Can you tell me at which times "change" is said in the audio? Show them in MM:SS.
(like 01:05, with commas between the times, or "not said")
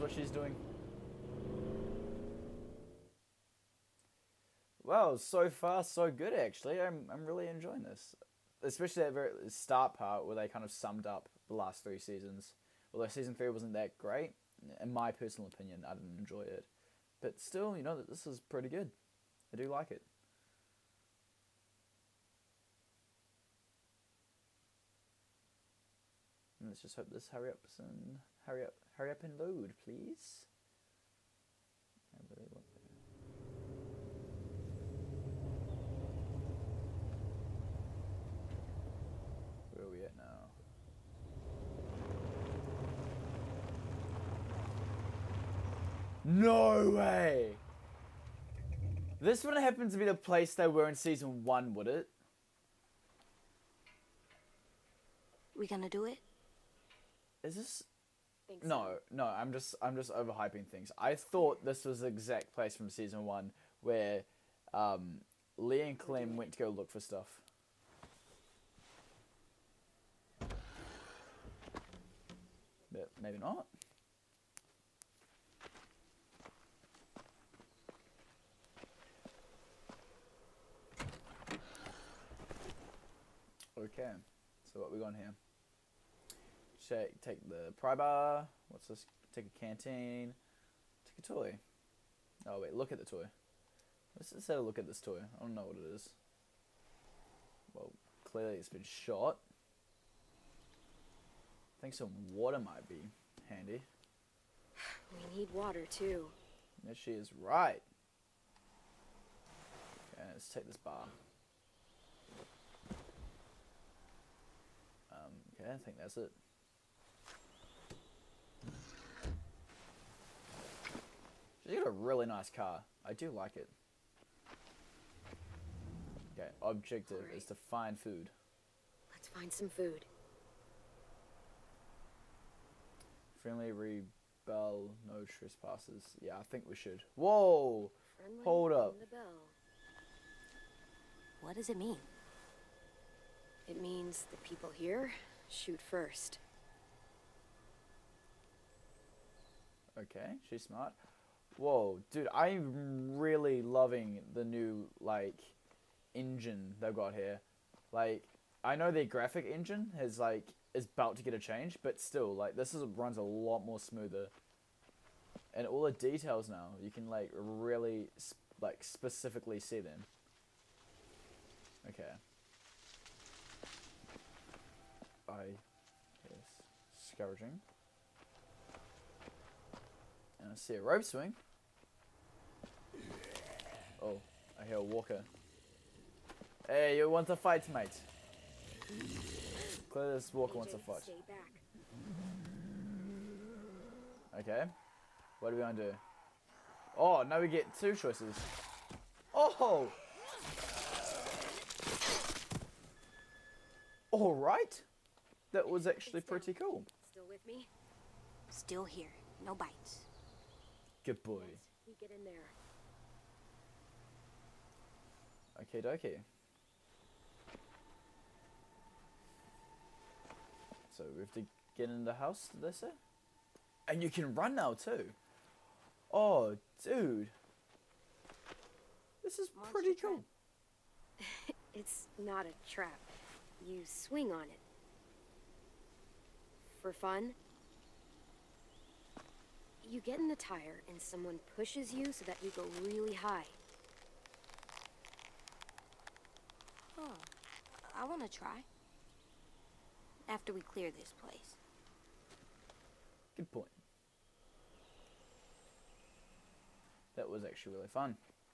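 02:41.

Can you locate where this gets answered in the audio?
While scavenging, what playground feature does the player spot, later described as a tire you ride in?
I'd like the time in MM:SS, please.
03:00.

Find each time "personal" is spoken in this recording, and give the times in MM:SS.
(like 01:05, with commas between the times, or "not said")
00:15.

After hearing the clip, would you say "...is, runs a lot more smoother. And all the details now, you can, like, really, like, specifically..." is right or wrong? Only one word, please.
right.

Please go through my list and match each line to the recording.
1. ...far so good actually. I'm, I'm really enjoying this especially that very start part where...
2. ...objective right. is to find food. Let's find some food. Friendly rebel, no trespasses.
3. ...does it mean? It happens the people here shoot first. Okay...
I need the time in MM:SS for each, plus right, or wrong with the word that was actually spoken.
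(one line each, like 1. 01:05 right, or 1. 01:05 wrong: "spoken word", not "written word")
1. 00:05 right
2. 02:06 right
3. 02:21 wrong: "means", not "happens".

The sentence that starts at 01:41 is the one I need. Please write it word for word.
I think some water might be handy.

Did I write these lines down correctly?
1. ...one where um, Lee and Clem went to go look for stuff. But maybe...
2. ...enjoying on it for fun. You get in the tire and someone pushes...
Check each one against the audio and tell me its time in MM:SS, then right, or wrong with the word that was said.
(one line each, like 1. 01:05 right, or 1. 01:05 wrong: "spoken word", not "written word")
1. 01:03 right
2. 03:53 wrong: "swing", not "enjoying".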